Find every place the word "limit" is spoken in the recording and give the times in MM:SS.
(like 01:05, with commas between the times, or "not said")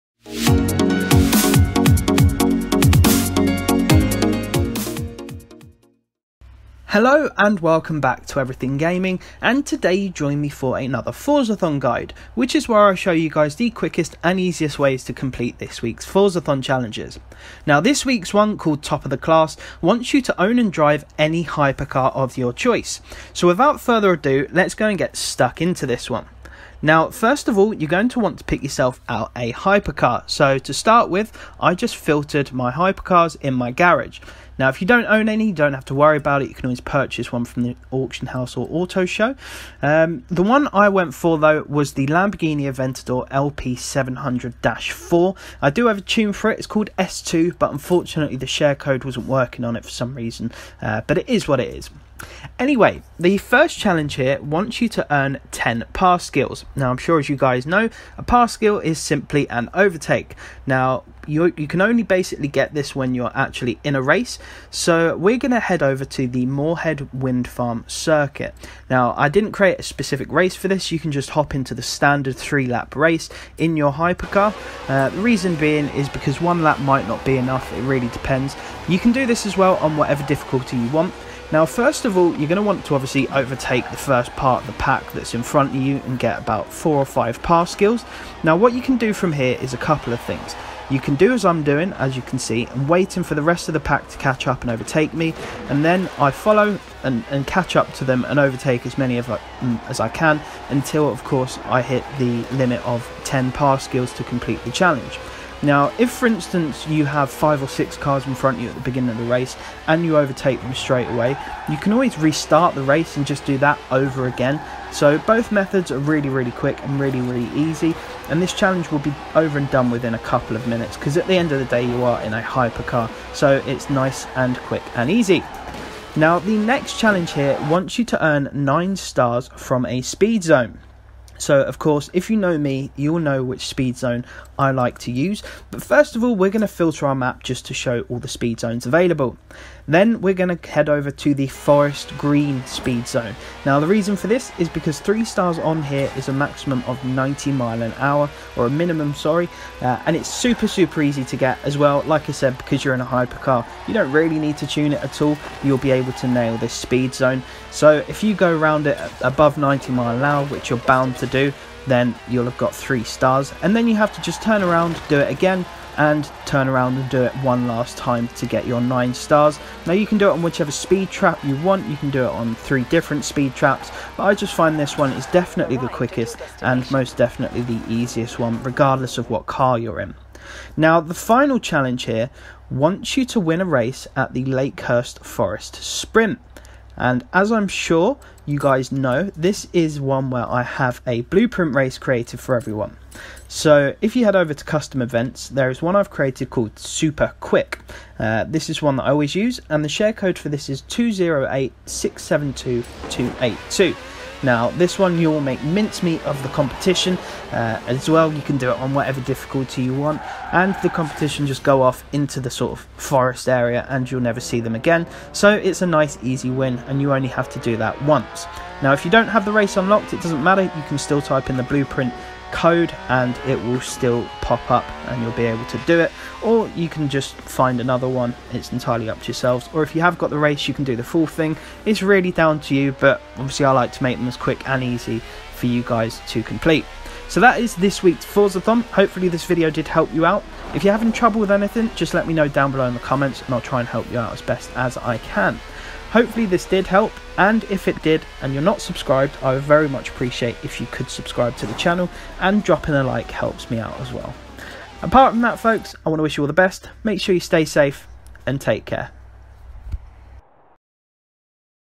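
01:42.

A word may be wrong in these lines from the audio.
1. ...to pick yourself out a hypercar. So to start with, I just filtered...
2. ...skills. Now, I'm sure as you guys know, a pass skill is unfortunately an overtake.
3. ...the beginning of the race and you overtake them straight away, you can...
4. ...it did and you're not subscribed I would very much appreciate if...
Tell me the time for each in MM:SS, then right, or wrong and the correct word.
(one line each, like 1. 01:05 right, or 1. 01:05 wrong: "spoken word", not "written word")
1. 00:28 right
2. 00:56 wrong: "simply", not "unfortunately"
3. 01:48 right
4. 04:07 right.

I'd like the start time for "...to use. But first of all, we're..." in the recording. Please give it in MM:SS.
02:14.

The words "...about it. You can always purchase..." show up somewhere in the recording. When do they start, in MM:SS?
00:36.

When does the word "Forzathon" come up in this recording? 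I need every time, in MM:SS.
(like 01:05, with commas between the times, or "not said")
00:11, 00:16.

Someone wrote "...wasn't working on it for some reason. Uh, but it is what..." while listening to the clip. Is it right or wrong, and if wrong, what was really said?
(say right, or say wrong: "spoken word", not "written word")
right.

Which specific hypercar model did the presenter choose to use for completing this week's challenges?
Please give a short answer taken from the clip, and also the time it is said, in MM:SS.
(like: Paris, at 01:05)
Lamborghini Aventador LP700 4, at 00:42.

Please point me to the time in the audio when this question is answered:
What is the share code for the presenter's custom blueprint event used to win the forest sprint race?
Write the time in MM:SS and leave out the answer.
03:20.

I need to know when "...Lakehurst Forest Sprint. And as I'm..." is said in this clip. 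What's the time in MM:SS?
03:04.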